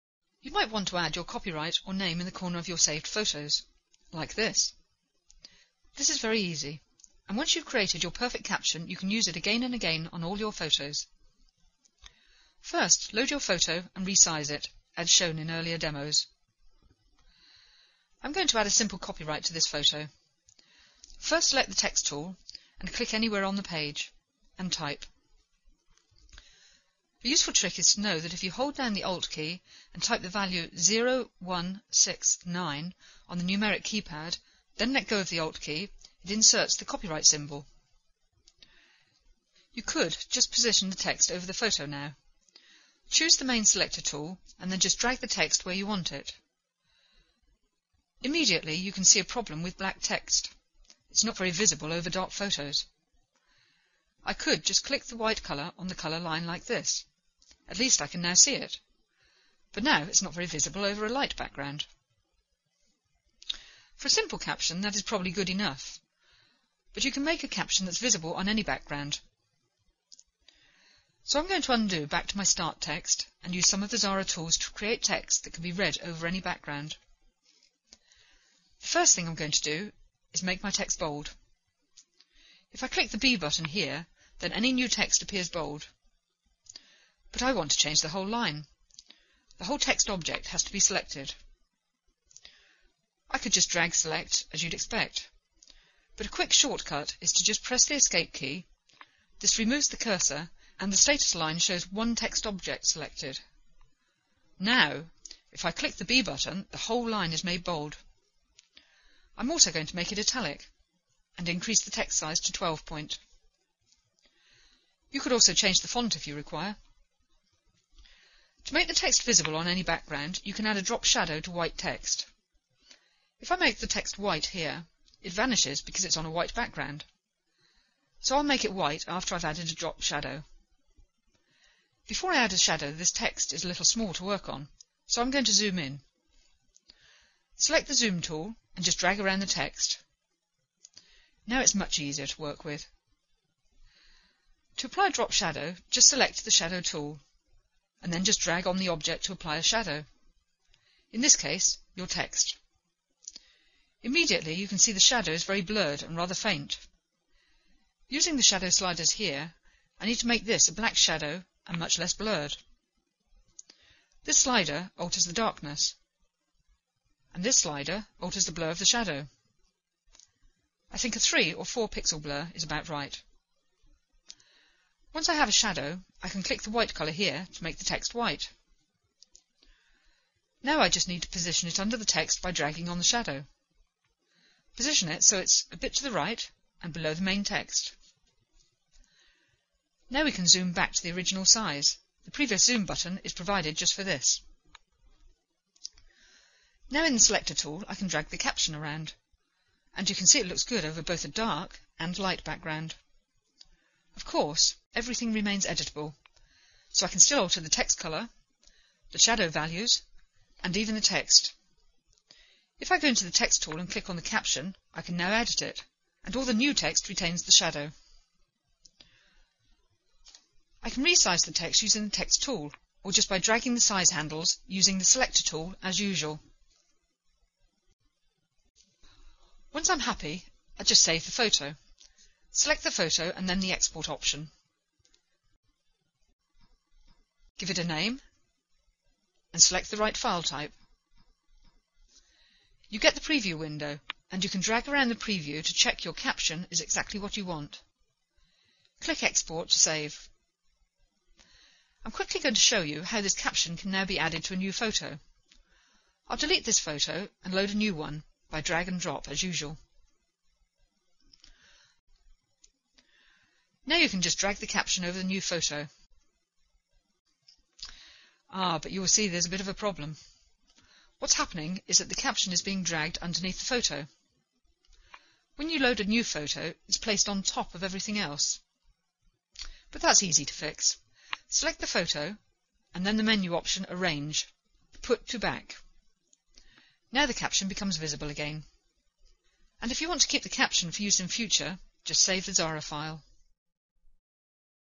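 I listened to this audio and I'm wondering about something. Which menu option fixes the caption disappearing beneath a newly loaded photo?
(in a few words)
Put to Back.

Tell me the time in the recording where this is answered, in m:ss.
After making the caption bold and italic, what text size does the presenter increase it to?
1:52.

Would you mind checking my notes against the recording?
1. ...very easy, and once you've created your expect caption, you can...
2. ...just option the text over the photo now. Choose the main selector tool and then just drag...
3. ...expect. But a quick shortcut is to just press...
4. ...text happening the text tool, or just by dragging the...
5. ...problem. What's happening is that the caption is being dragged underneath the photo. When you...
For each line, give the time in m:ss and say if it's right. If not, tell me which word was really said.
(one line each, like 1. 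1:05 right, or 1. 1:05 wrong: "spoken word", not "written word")
1. 0:06 wrong: "perfect", not "expect"
2. 0:40 wrong: "position", not "option"
3. 1:34 right
4. 3:41 wrong: "using", not "happening"
5. 4:29 right.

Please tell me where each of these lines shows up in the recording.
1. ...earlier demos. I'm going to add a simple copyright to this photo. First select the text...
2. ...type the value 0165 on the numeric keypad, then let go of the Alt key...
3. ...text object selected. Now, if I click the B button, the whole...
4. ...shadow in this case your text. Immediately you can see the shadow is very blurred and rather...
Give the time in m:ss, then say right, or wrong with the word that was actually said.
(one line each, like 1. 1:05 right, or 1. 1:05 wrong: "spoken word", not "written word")
1. 0:15 right
2. 0:30 wrong: "0169", not "0165"
3. 1:42 right
4. 2:29 right.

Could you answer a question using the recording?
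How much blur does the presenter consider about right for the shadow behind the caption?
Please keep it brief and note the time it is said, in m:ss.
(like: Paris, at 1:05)
3 or 4 pixel, at 2:51.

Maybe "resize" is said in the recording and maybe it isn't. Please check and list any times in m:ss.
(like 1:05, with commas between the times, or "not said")
0:14, 3:41.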